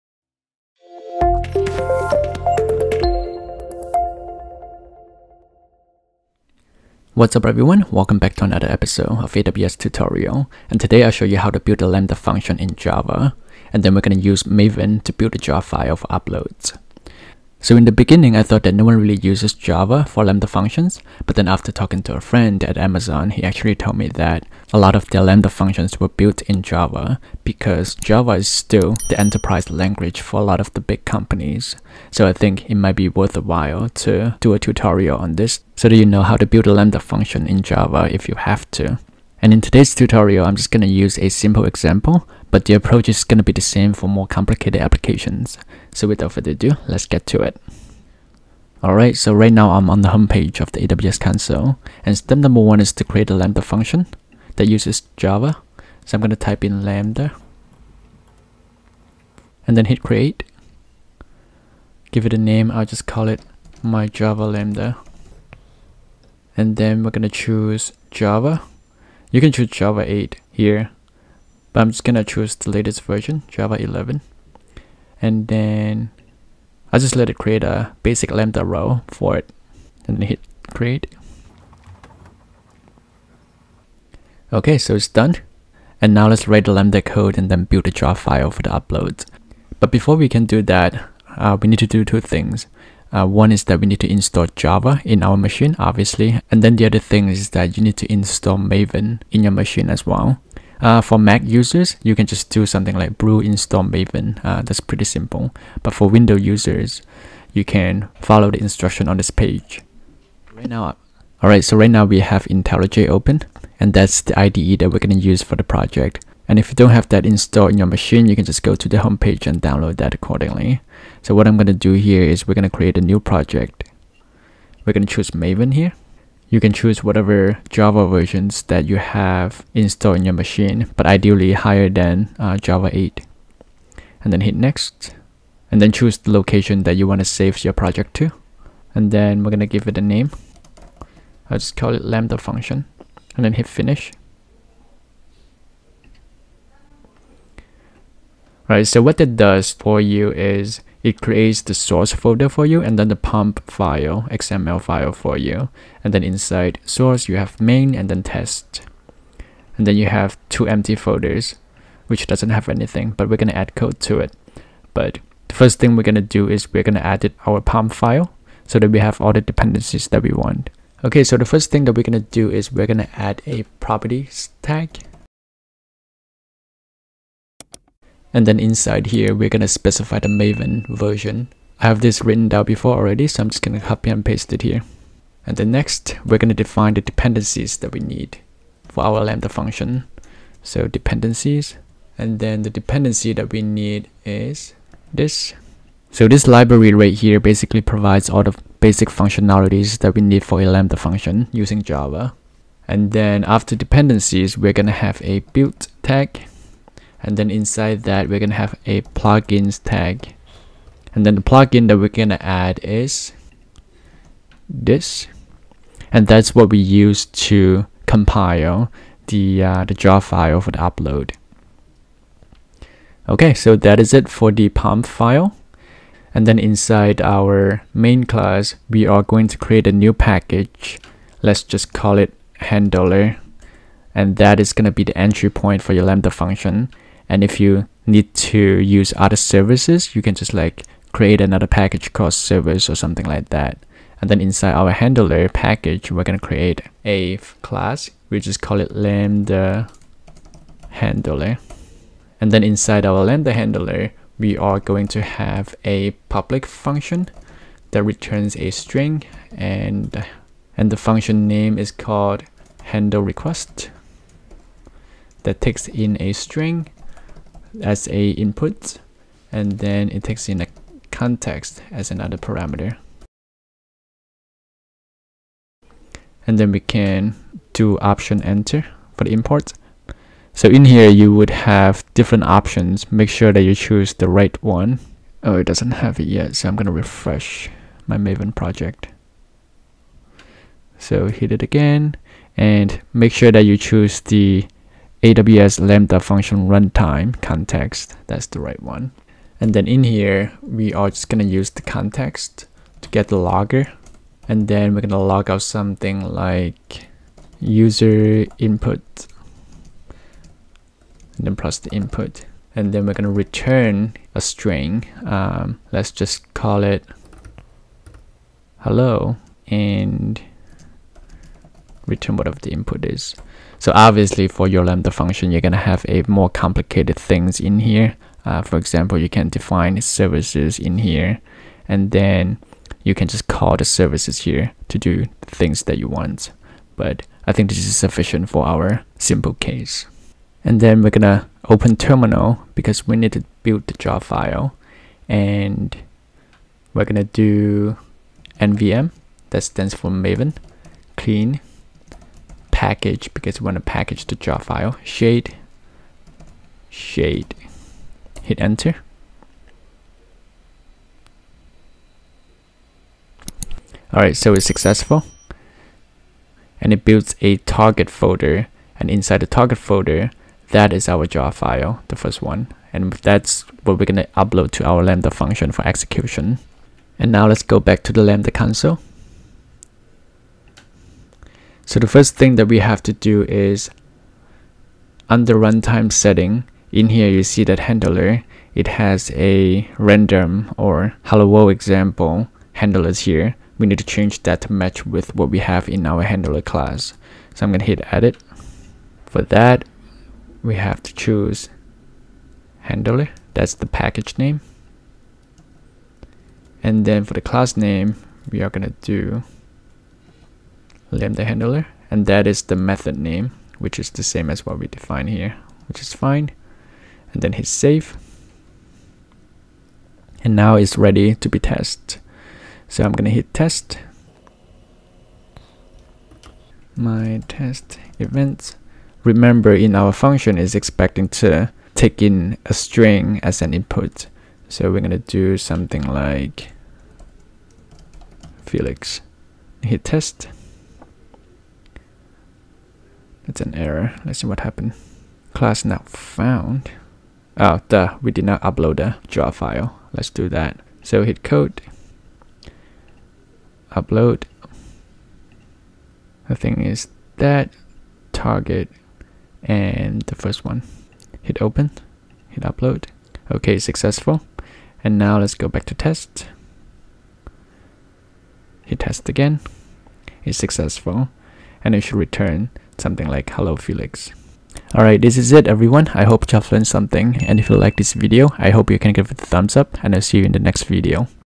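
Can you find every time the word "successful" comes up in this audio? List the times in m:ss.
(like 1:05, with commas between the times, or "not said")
6:04, 7:43, 7:50.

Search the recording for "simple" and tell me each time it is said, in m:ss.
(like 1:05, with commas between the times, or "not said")
0:41, 1:45, 5:39.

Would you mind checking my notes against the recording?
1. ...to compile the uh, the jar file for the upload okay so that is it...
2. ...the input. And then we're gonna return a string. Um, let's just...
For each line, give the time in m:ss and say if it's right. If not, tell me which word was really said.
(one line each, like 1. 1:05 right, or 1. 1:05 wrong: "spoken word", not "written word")
1. 3:37 right
2. 5:11 right.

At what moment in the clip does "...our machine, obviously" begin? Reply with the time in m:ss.
1:35.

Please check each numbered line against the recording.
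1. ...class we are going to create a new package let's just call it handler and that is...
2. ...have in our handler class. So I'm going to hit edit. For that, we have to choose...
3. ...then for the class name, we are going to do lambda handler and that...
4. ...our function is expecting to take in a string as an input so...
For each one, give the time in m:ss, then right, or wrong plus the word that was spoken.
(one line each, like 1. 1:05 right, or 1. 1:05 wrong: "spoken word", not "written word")
1. 3:48 right
2. 6:35 right
3. 6:47 right
4. 7:09 right.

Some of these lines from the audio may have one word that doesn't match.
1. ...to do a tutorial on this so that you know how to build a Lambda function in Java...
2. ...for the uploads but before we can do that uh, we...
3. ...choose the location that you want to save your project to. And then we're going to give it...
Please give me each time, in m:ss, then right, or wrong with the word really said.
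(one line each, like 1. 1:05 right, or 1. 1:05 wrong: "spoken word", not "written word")
1. 0:33 right
2. 1:28 right
3. 2:15 right.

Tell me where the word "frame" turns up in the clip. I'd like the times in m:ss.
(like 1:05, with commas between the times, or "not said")
not said.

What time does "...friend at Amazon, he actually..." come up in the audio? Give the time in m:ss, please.
0:22.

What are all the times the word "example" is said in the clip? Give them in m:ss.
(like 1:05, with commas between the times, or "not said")
0:41, 5:28, 6:31.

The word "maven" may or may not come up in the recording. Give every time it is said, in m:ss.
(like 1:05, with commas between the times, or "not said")
0:14, 1:38, 1:43, 2:05, 3:00, 4:48, 5:50.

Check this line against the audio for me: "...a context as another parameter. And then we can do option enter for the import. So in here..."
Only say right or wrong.
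right.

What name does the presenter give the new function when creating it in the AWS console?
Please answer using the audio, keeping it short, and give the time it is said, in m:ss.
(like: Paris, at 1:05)
my Java Lambda, at 1:03.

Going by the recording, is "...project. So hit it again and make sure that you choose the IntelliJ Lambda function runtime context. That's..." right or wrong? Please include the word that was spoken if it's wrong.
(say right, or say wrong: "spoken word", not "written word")
wrong: "AWS", not "IntelliJ".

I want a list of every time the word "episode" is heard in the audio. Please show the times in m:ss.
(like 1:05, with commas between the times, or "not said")
0:08.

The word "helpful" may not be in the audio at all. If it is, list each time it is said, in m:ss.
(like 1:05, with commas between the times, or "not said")
not said.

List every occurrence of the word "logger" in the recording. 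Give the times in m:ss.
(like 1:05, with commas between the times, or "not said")
5:03.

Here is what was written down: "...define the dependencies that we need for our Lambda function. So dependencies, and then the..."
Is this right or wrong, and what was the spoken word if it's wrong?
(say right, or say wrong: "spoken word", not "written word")
right.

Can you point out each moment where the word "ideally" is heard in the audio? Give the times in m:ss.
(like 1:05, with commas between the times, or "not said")
2:11.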